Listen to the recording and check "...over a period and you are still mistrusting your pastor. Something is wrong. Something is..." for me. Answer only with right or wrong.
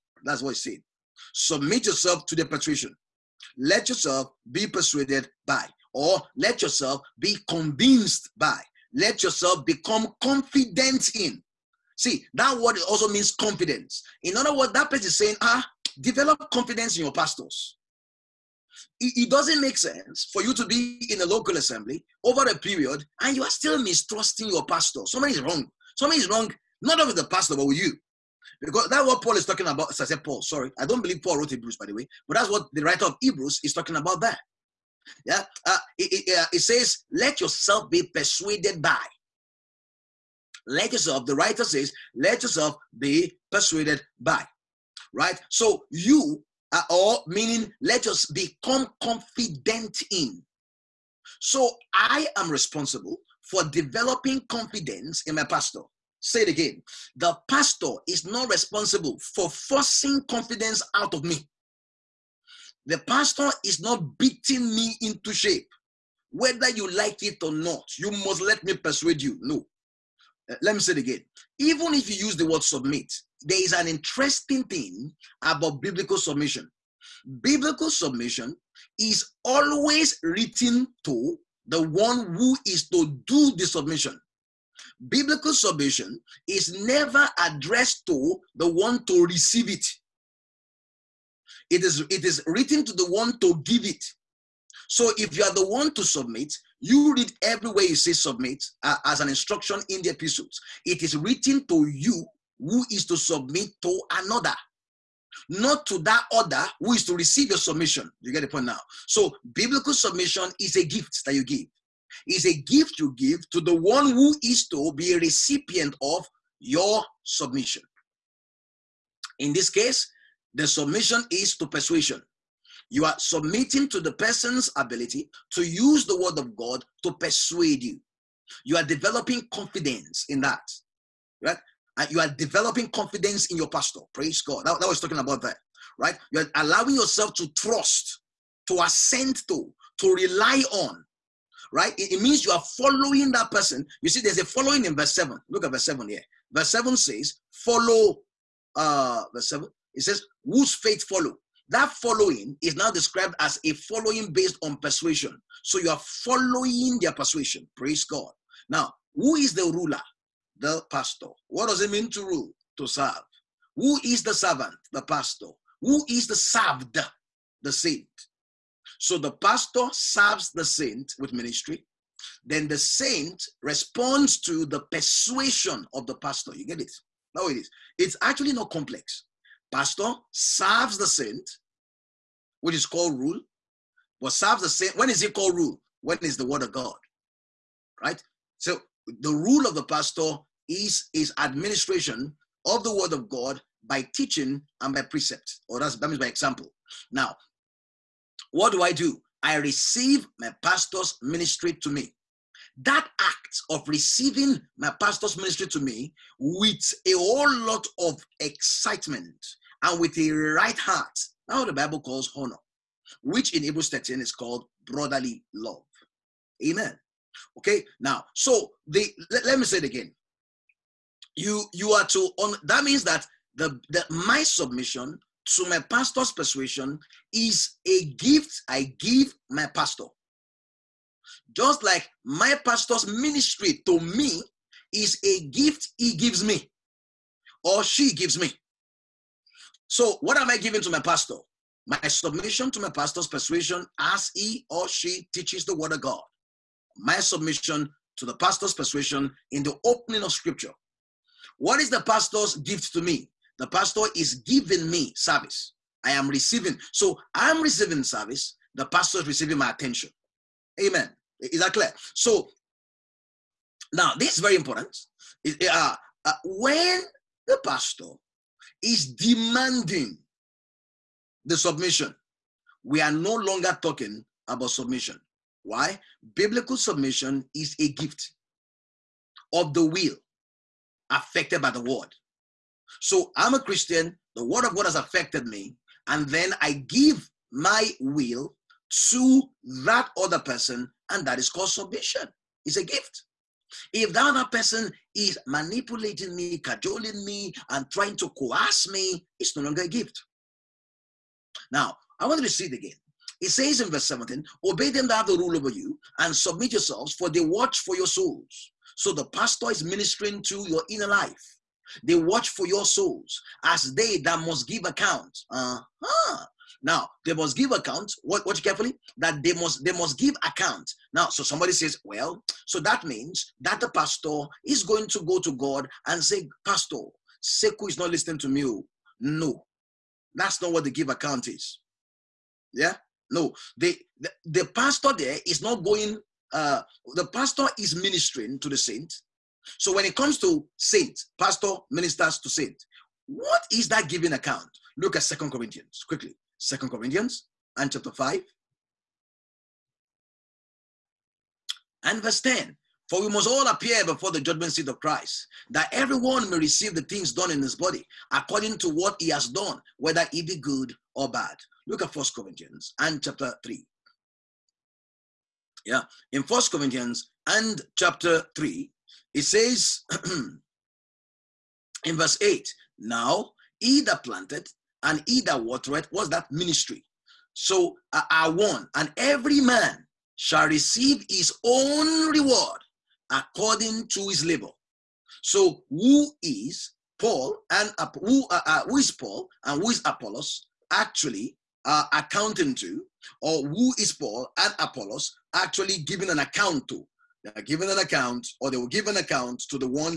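right.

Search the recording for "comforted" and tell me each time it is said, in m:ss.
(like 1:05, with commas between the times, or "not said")
not said.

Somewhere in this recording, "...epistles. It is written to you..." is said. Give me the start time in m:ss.
1:40.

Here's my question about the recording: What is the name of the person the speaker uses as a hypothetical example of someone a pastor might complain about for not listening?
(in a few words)
Sekou.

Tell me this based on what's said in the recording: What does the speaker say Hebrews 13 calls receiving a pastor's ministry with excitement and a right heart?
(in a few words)
Brotherly love.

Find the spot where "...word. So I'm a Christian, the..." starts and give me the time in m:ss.
4:41.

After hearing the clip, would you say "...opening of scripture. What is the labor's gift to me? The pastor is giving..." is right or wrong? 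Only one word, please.
wrong.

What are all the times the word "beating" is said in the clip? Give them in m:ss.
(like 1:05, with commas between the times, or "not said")
1:04.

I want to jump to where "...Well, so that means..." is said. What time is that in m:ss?
5:22.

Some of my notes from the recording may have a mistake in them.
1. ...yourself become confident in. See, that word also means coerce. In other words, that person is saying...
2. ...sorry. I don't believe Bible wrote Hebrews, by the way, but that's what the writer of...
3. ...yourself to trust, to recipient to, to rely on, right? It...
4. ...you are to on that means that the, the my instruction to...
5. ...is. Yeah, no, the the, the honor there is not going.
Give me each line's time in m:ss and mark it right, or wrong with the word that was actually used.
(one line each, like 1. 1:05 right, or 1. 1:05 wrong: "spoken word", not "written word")
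1. 0:09 wrong: "confidence", not "coerce"
2. 0:30 wrong: "Paul", not "Bible"
3. 2:16 wrong: "assent", not "recipient"
4. 3:41 wrong: "submission", not "instruction"
5. 5:31 wrong: "pastor", not "honor".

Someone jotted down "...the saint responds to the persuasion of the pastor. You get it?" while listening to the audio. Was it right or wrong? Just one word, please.
right.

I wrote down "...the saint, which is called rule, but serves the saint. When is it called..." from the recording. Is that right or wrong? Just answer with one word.
right.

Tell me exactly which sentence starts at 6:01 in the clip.
Look at First Corinthians and chapter 3.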